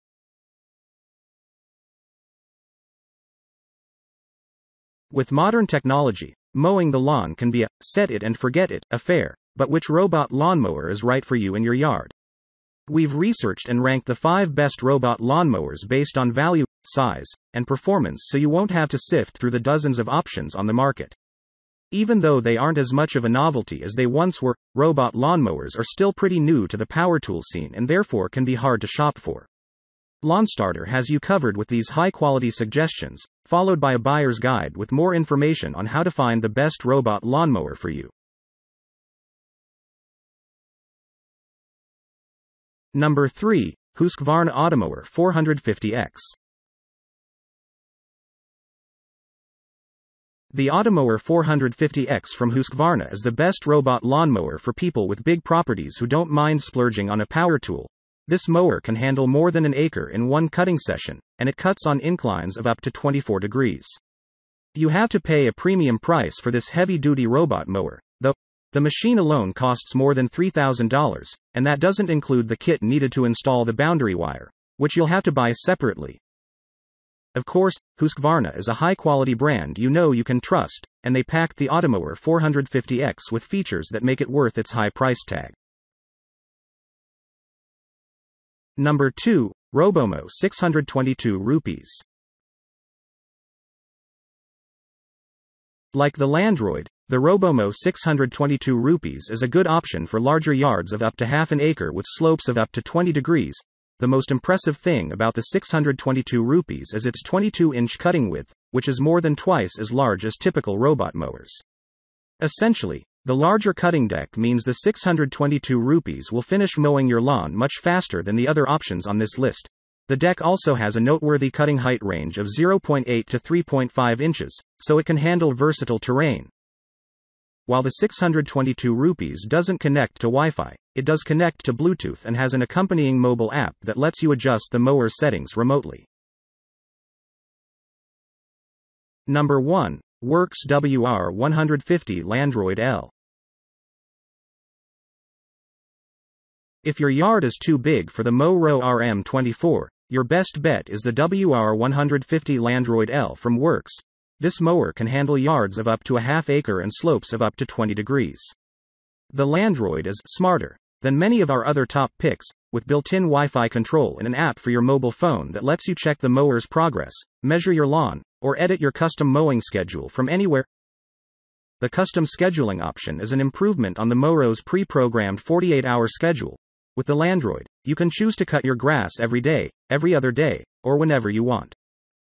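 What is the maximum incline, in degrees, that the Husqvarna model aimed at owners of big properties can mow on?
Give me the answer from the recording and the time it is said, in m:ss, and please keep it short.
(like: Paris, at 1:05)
24 degrees, at 1:02.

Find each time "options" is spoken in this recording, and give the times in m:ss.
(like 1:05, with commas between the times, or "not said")
0:20, 1:39, 1:58, 2:52.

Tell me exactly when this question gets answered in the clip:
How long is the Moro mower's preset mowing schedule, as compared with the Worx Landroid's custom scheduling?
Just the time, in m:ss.
2:55.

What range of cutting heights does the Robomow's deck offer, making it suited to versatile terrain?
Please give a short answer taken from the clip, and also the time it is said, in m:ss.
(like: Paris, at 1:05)
0.8 to 3.5 inches, at 2:02.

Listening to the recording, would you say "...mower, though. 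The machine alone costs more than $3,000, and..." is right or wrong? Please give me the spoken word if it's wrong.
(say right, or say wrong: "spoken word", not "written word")
right.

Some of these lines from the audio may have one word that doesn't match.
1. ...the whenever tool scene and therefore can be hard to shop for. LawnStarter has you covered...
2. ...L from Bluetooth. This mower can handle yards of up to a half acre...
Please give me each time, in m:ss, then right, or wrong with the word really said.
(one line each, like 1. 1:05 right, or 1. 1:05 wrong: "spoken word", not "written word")
1. 0:26 wrong: "power", not "whenever"
2. 2:33 wrong: "Worx", not "Bluetooth".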